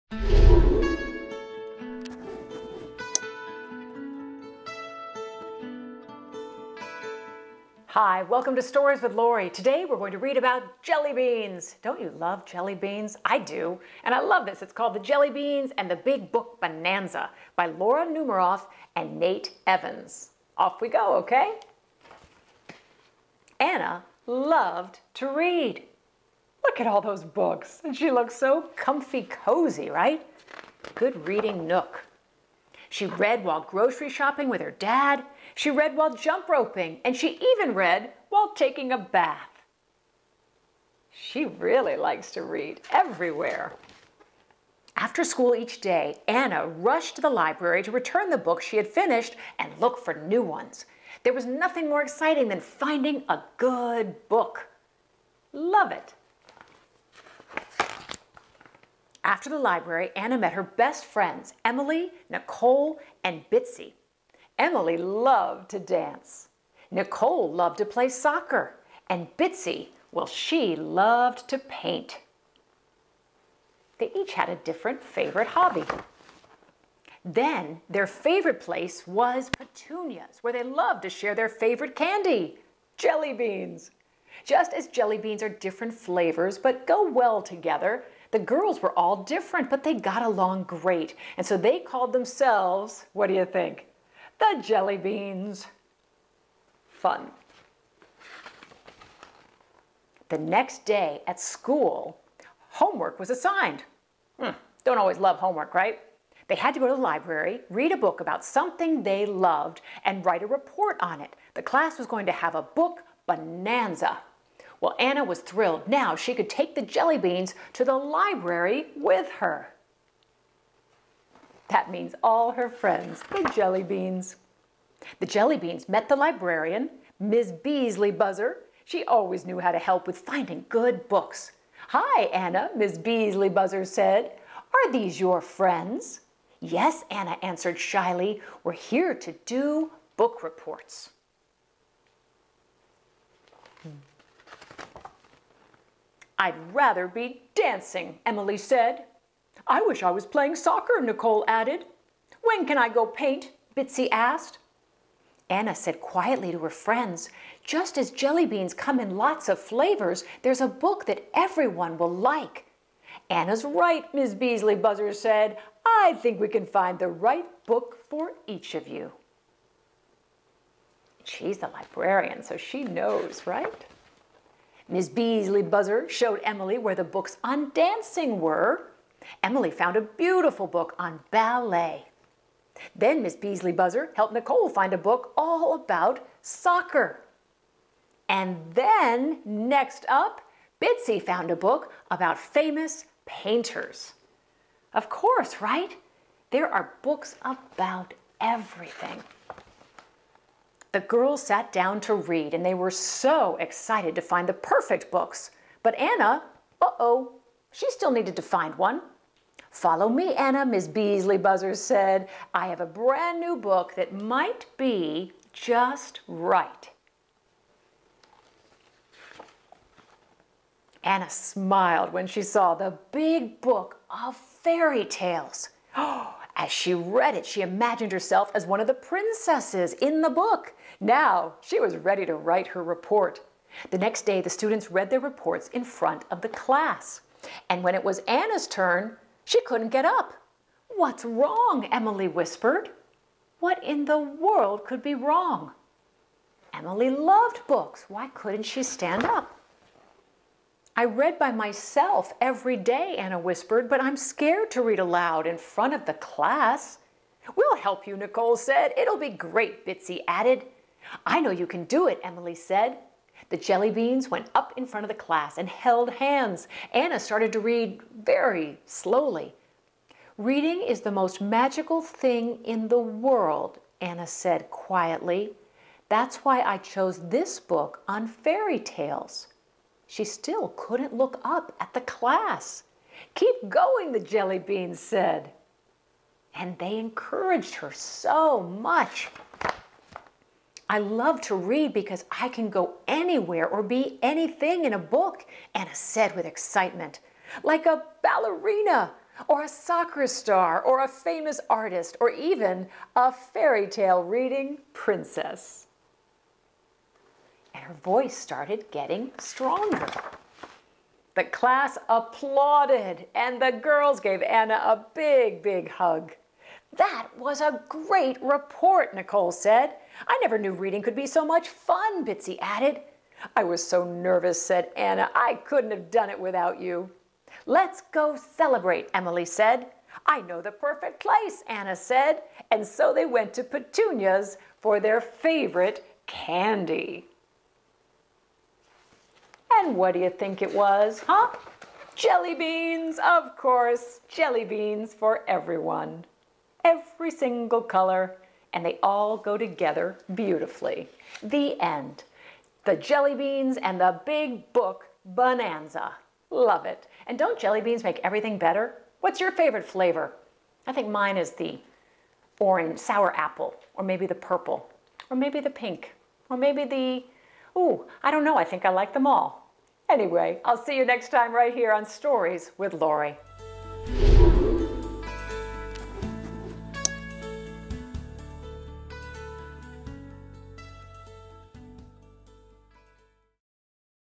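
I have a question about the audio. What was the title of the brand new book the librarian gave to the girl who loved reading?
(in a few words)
The big book of fairy tales.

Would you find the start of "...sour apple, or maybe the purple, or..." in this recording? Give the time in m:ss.
6:02.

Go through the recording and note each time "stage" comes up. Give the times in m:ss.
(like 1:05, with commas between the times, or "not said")
not said.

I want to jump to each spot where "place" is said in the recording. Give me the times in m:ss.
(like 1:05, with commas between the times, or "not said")
1:18, 5:31.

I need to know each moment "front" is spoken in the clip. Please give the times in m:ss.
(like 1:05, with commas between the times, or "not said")
3:55, 4:15, 4:24.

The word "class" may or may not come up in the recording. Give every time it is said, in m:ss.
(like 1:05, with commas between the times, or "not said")
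1:51, 3:56, 4:16, 4:25, 4:42, 5:11.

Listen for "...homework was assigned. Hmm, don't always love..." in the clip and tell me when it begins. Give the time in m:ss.
1:42.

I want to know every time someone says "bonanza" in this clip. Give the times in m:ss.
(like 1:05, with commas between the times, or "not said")
0:16, 1:53, 5:55.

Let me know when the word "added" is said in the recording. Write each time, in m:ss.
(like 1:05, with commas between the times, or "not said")
2:31, 4:20, 5:22.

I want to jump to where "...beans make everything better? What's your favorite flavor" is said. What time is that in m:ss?
5:57.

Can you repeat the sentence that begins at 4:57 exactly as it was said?
Like a ballerina, or a soccer star, or a famous artist, or even a fairy tale reading princess.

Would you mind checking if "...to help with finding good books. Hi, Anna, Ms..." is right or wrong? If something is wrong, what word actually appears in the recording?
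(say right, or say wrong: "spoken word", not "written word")
right.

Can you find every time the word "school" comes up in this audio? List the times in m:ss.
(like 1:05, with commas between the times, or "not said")
0:45, 1:41.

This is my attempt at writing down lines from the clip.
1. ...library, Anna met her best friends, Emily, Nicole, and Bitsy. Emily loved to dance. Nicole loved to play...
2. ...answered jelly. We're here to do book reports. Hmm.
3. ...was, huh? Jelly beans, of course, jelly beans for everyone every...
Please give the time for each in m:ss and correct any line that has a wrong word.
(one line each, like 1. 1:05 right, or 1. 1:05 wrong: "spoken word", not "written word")
1. 0:59 right
2. 2:17 wrong: "shyly", not "jelly"
3. 5:40 right.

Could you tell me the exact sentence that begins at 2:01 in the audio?
That means all her friends, the jelly beans.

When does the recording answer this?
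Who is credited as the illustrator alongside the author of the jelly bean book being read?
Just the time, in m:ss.
0:19.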